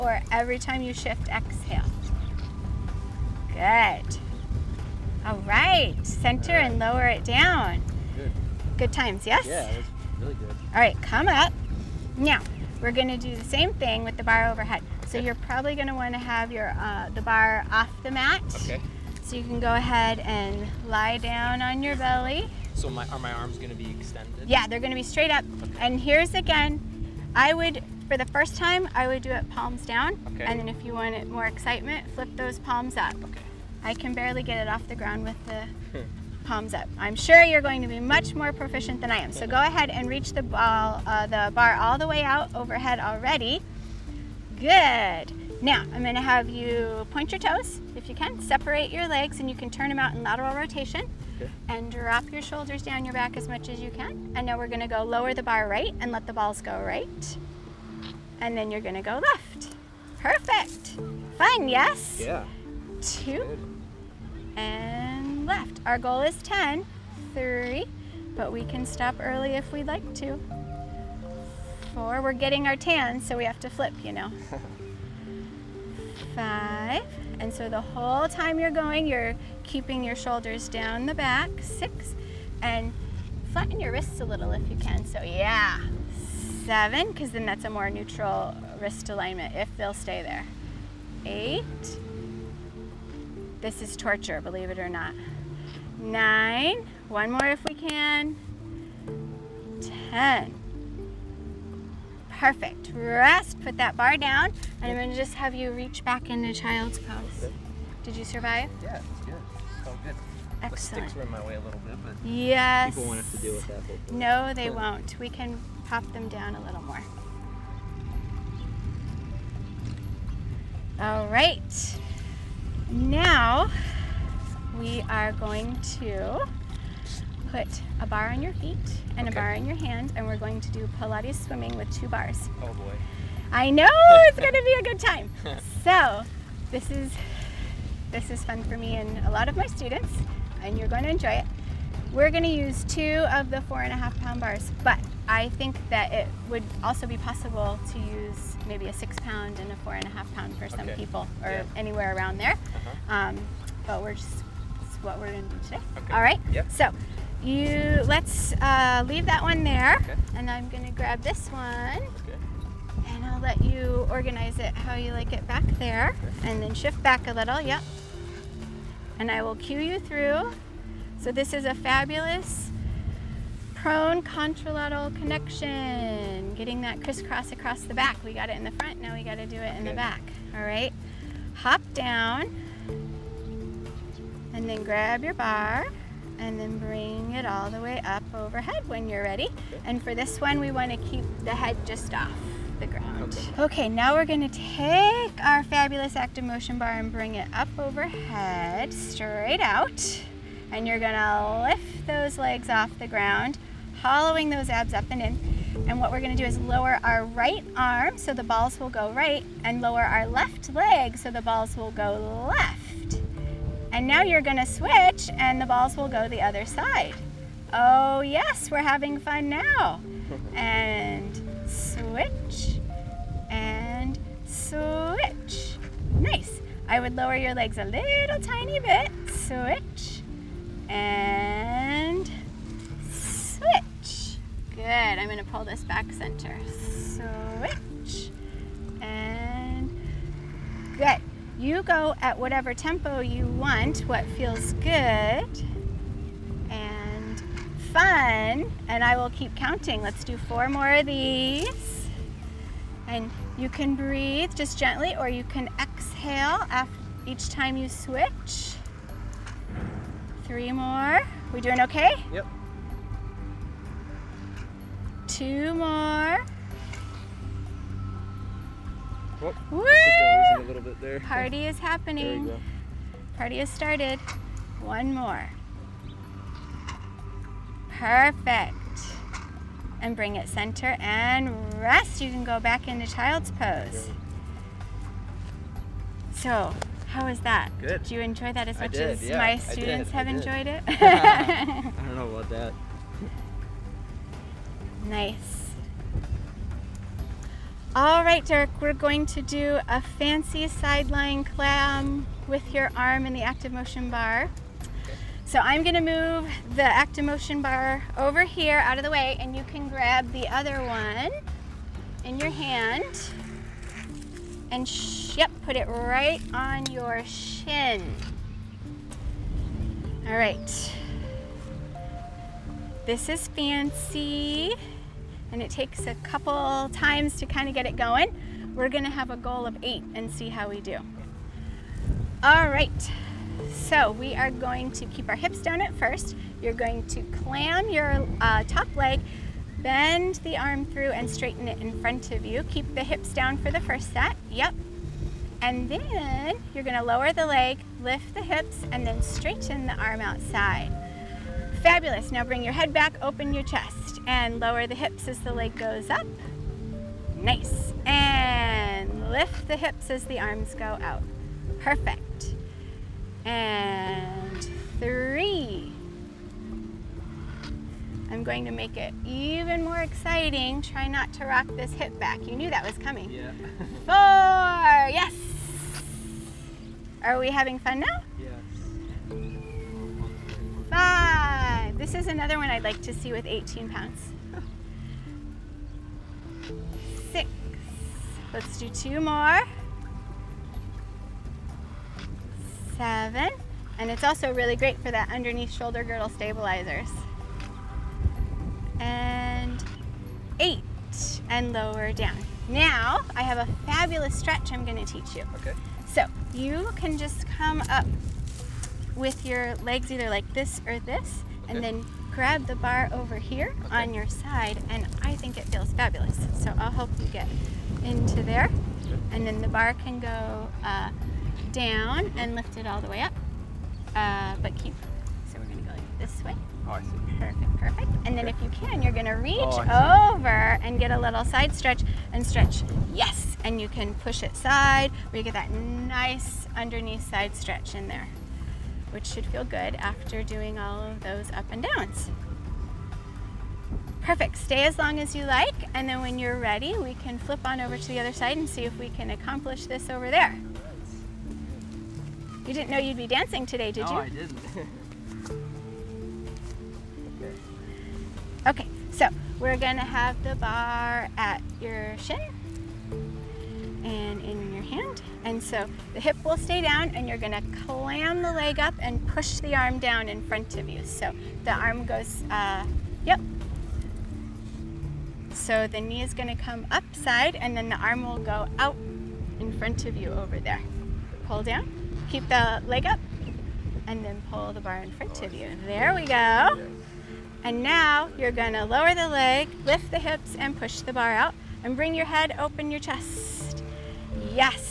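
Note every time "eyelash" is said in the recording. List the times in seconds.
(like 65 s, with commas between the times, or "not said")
not said.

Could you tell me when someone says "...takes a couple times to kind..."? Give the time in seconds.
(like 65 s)
325 s.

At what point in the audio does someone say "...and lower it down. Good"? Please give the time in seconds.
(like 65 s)
6 s.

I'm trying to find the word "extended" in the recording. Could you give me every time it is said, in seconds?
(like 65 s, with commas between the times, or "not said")
23 s.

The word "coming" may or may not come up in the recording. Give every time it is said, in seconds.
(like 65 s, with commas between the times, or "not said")
372 s.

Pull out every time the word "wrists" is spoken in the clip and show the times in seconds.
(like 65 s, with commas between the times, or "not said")
83 s, 88 s.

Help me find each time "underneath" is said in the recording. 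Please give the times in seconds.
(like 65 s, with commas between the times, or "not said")
395 s, 436 s.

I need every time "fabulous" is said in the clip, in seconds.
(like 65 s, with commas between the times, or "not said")
171 s, 195 s, 351 s, 403 s, 415 s.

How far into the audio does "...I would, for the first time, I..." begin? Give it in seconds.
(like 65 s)
27 s.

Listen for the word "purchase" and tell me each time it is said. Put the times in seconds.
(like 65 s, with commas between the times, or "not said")
not said.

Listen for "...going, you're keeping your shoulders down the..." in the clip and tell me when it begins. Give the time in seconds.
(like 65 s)
78 s.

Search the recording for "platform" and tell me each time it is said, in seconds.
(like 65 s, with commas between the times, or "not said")
not said.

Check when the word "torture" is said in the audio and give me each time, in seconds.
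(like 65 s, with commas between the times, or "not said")
93 s.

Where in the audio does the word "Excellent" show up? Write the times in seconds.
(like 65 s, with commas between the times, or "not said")
110 s.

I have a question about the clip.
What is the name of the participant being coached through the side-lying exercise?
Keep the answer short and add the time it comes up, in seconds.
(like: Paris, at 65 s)
Derek, at 298 s.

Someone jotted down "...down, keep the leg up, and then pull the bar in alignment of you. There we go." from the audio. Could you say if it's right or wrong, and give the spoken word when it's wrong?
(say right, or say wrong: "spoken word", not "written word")
wrong: "front", not "alignment".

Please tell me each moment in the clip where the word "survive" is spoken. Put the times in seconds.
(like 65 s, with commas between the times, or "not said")
108 s.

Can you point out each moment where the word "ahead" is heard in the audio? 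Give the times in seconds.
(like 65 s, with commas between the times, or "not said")
19 s, 39 s.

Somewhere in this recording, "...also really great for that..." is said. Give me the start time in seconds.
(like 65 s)
394 s.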